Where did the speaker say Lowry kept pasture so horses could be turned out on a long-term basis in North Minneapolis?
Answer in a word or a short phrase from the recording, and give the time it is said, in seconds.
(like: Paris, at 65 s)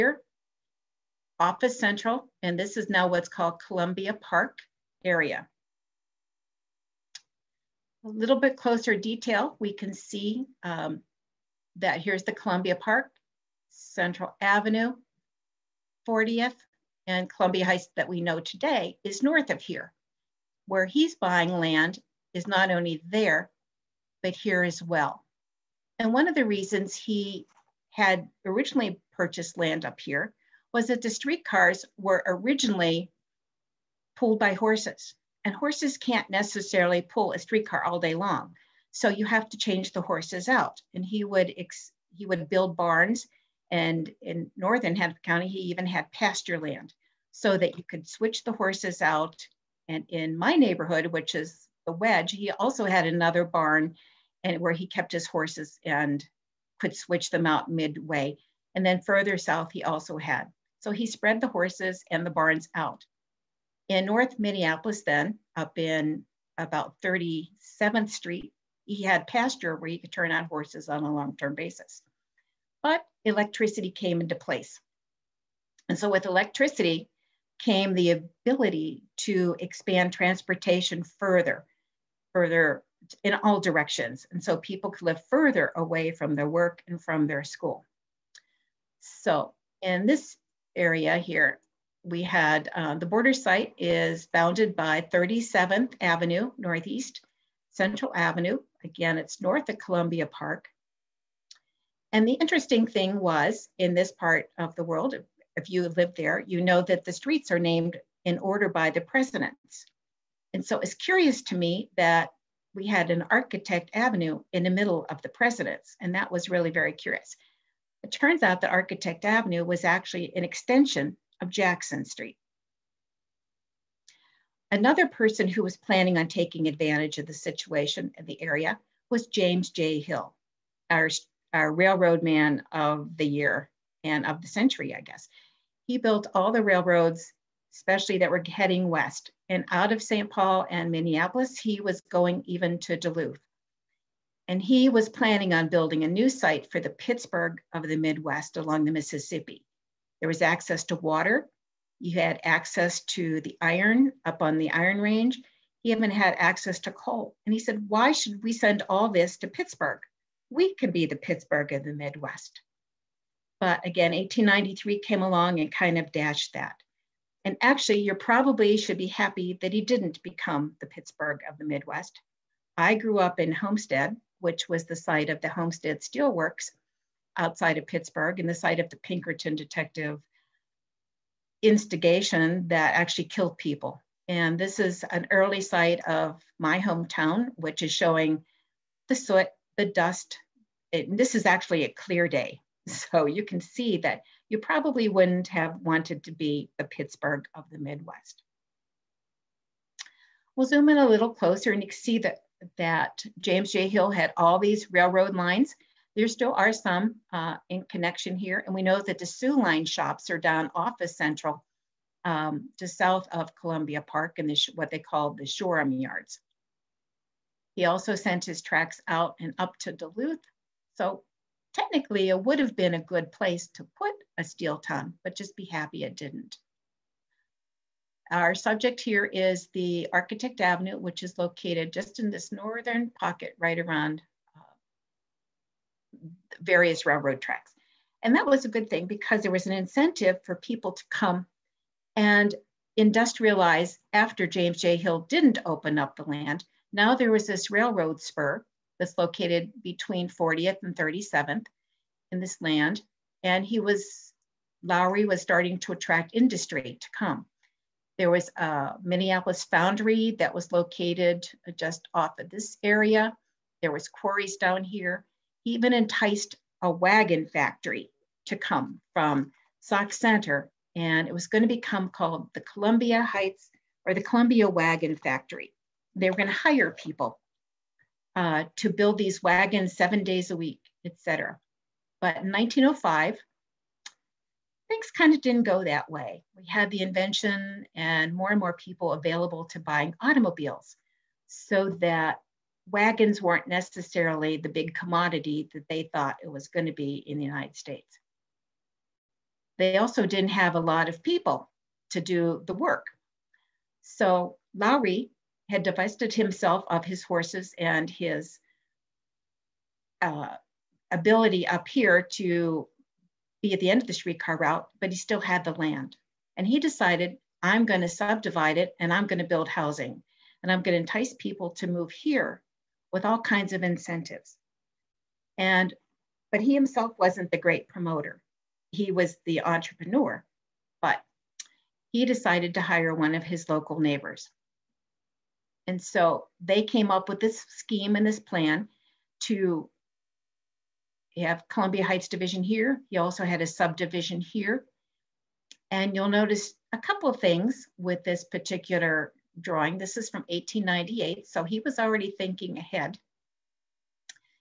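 37th Street, at 67 s.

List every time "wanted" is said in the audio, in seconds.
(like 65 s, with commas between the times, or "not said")
195 s.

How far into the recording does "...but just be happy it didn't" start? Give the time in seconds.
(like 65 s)
225 s.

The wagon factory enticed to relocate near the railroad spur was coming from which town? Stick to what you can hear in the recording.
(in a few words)
Sauk Centre.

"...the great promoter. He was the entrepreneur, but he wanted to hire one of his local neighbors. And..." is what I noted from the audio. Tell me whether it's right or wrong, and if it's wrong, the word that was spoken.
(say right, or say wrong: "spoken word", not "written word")
wrong: "decided", not "wanted".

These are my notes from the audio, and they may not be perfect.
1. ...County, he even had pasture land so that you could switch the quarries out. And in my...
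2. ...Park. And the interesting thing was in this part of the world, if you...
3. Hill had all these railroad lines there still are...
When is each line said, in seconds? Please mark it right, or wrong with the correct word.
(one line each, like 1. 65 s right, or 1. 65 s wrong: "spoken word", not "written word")
1. 45 s wrong: "horses", not "quarries"
2. 100 s right
3. 203 s right.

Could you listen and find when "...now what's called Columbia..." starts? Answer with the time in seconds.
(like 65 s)
2 s.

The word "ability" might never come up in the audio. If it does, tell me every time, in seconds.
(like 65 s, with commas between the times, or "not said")
78 s, 311 s.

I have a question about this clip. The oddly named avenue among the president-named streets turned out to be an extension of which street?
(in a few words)
Jackson Street.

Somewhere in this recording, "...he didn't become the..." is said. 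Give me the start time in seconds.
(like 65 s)
169 s.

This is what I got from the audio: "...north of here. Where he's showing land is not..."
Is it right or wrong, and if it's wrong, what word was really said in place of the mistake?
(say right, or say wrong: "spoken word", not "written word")
wrong: "buying", not "showing".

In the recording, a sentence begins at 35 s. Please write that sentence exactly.
And horses can't necessarily pull a streetcar all day long.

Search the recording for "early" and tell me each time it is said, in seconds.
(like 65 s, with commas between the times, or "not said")
185 s.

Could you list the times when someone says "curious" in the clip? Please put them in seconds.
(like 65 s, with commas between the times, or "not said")
110 s, 116 s.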